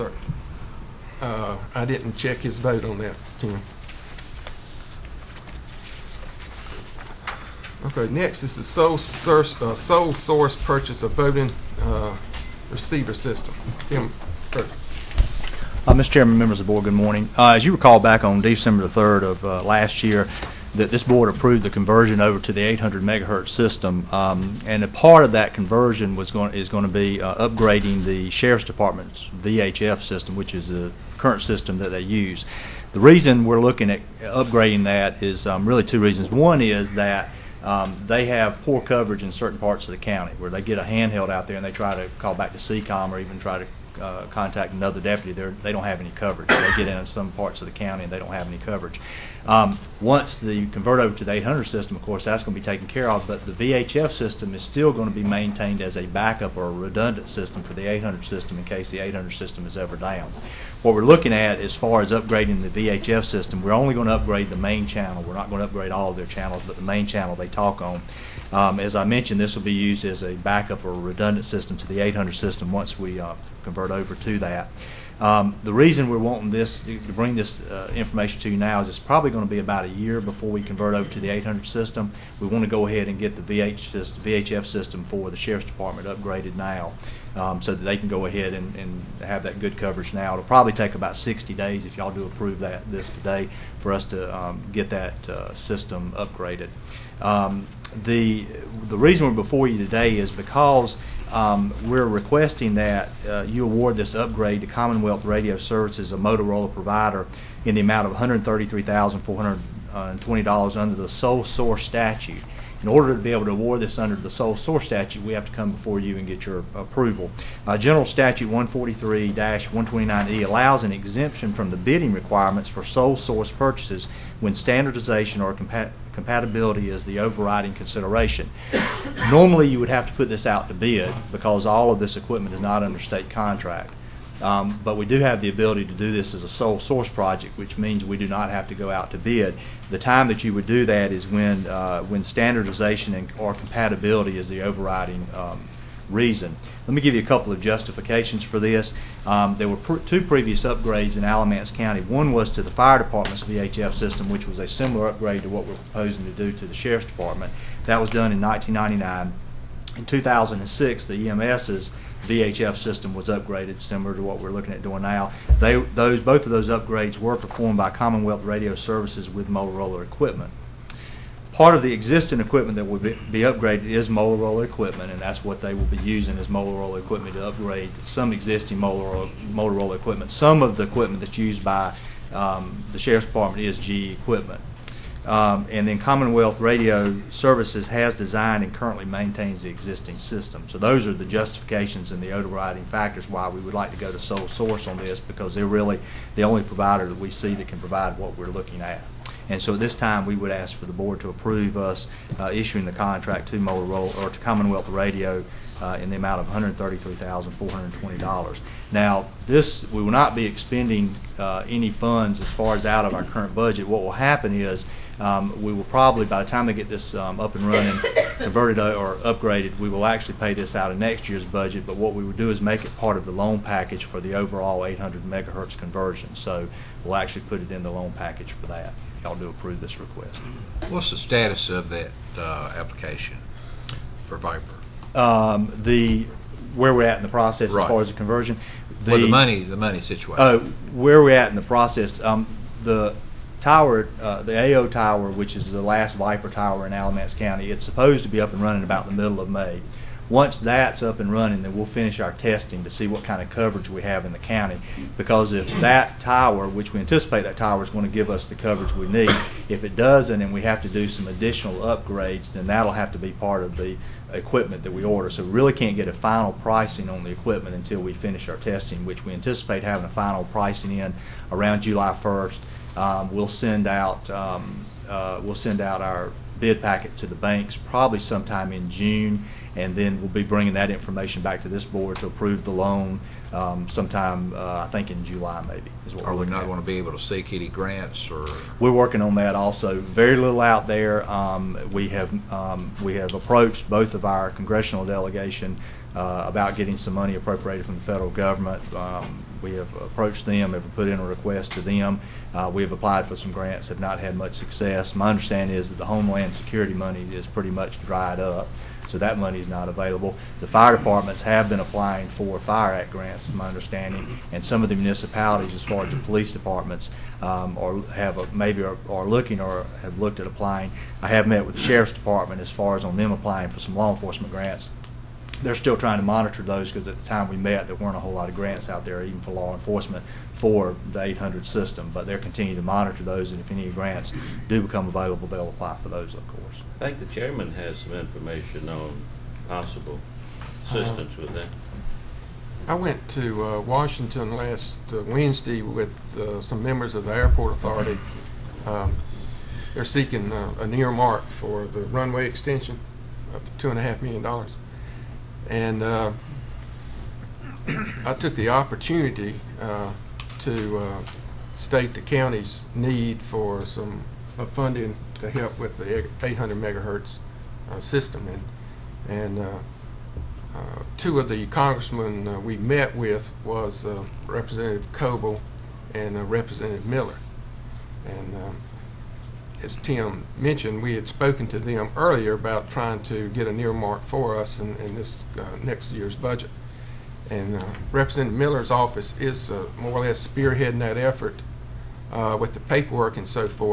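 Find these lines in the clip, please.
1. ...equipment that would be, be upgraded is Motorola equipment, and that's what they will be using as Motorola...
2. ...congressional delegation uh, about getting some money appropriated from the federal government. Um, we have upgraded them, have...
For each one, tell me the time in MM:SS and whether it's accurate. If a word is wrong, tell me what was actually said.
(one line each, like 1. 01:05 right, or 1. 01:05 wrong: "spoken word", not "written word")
1. 02:52 right
2. 04:54 wrong: "approached", not "upgraded".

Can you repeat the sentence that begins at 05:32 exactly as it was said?
But they're continuing to monitor those, and if any grants do become available, they'll apply for those, of course.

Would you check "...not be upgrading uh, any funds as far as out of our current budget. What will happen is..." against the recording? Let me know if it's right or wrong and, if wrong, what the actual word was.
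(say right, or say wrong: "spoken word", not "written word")
wrong: "expending", not "upgrading".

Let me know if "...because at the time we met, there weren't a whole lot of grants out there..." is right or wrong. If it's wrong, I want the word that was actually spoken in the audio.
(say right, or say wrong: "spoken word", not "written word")
right.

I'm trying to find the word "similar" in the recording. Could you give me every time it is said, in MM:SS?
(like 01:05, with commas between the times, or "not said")
02:34, 02:43.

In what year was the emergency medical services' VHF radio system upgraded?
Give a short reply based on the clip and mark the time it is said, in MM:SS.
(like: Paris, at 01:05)
2006, at 02:40.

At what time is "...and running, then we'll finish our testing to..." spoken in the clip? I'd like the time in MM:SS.
04:11.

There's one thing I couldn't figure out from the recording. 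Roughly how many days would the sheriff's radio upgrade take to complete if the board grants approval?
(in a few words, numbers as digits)
60 days.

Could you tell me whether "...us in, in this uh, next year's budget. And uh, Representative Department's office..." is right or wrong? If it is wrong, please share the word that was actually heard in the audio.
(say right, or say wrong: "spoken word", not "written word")
wrong: "Miller", not "Department".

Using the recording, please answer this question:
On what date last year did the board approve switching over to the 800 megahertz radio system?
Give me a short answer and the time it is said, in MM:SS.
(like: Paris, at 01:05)
December 3, at 00:18.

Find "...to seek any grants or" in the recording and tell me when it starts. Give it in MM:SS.
04:47.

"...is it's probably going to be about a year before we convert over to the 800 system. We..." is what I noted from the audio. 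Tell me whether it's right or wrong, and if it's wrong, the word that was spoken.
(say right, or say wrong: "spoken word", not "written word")
right.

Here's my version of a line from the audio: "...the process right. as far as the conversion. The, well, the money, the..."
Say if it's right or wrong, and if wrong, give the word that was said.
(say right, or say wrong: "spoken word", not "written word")
right.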